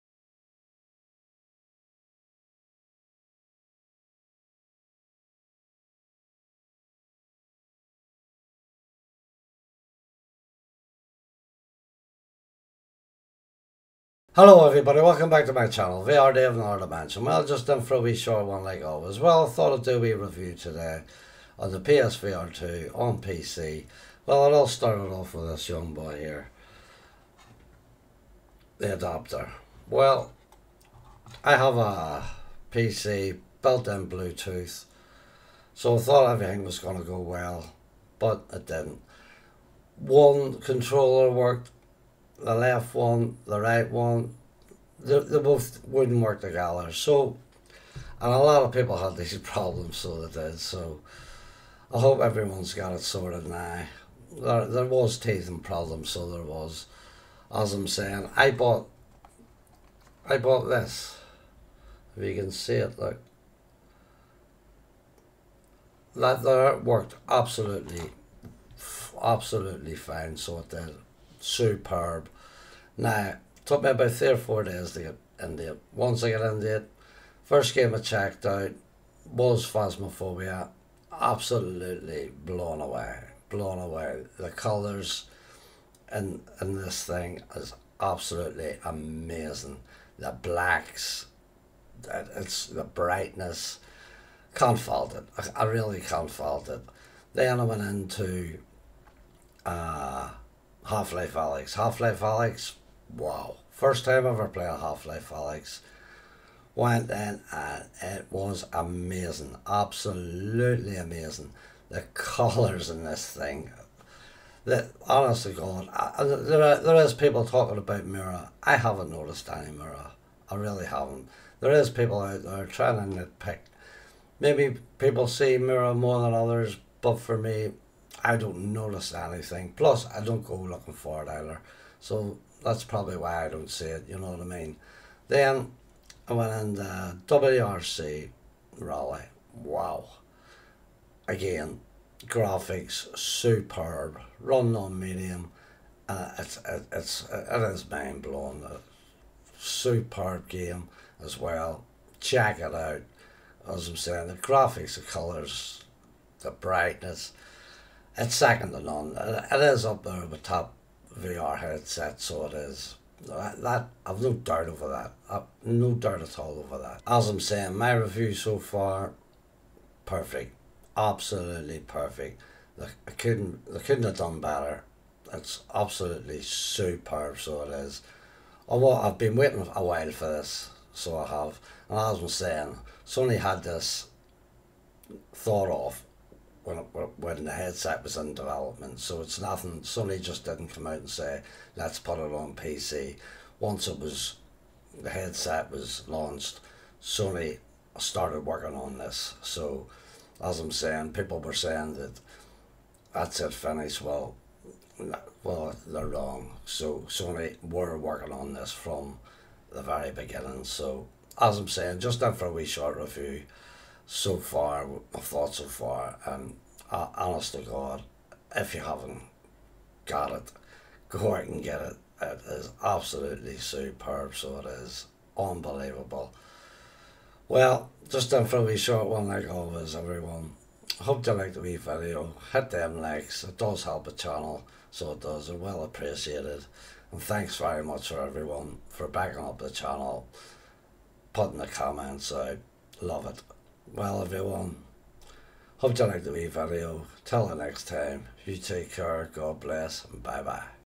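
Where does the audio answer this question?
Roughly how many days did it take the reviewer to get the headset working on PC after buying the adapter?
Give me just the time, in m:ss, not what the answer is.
1:14.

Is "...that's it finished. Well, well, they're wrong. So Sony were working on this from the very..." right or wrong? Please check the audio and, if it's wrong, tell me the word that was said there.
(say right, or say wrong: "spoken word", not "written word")
right.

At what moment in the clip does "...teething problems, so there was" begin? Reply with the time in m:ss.
0:55.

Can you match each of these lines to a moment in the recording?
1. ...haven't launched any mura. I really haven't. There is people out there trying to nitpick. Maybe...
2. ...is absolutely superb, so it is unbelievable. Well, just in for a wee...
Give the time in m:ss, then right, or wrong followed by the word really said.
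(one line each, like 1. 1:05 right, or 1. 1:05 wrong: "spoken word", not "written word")
1. 1:58 wrong: "noticed", not "launched"
2. 3:42 right.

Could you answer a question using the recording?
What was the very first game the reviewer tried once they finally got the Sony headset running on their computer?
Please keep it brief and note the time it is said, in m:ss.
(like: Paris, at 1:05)
Phasmophobia, at 1:19.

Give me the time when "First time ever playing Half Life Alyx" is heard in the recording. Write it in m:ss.
1:43.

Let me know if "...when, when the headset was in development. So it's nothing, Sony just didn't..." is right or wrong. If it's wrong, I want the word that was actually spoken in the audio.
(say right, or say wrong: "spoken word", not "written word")
right.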